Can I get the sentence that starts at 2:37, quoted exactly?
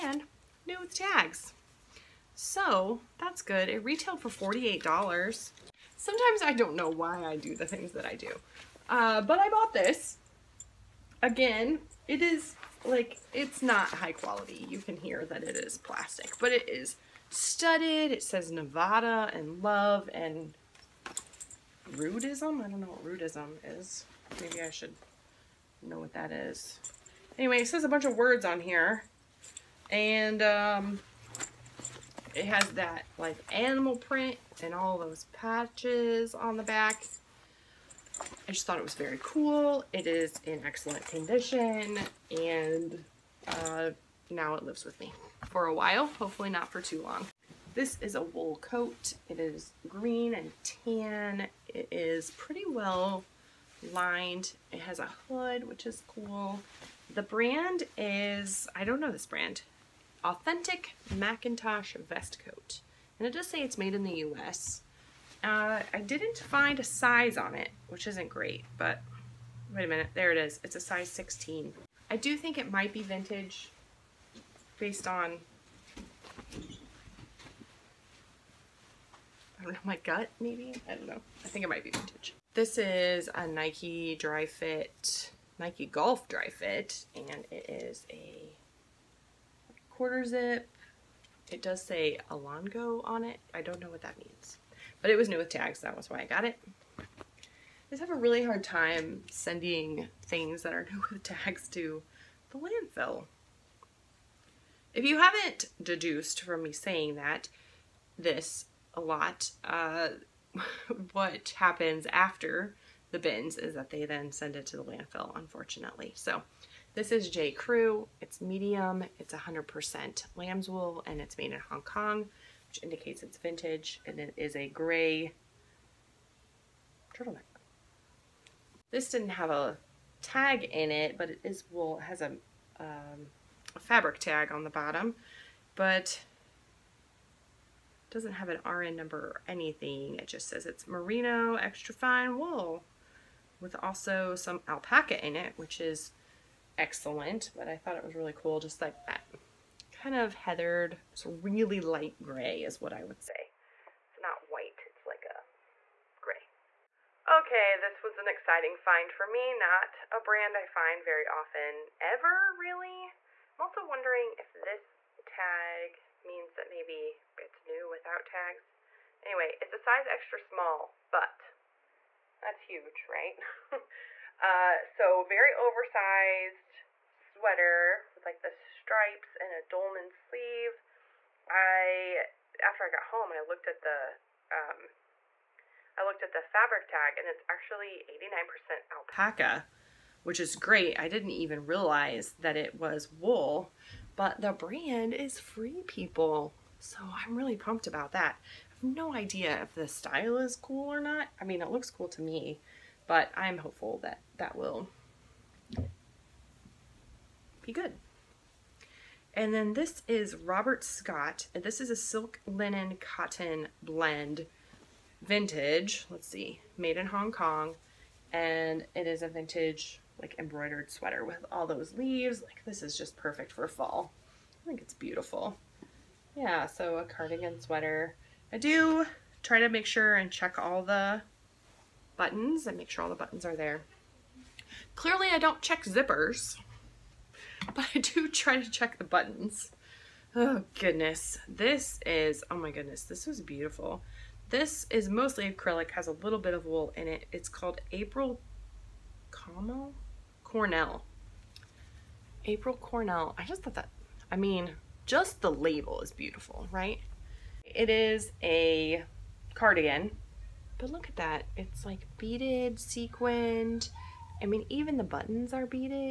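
Okay, this was an exciting find for me, not a brand I find very often ever, really.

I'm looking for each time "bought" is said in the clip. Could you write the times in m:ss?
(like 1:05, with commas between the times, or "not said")
0:09.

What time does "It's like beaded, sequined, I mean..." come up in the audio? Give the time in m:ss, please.
4:21.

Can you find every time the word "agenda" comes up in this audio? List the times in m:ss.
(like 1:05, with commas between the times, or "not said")
not said.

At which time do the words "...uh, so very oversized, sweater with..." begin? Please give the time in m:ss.
2:54.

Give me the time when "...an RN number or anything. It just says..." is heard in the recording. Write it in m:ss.
2:18.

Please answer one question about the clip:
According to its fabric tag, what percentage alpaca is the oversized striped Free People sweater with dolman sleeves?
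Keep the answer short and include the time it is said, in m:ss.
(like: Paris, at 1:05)
89%, at 3:08.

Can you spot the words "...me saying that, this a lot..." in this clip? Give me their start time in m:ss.
1:46.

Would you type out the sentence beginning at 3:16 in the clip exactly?
So I'm really pumped about that.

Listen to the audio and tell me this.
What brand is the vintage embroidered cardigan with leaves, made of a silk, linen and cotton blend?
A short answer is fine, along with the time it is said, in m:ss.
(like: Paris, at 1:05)
Robert Scott, at 3:30.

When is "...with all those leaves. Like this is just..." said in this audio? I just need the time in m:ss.
3:41.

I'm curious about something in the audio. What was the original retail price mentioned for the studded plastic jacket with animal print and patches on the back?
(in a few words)
$48.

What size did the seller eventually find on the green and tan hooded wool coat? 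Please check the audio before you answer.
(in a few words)
16.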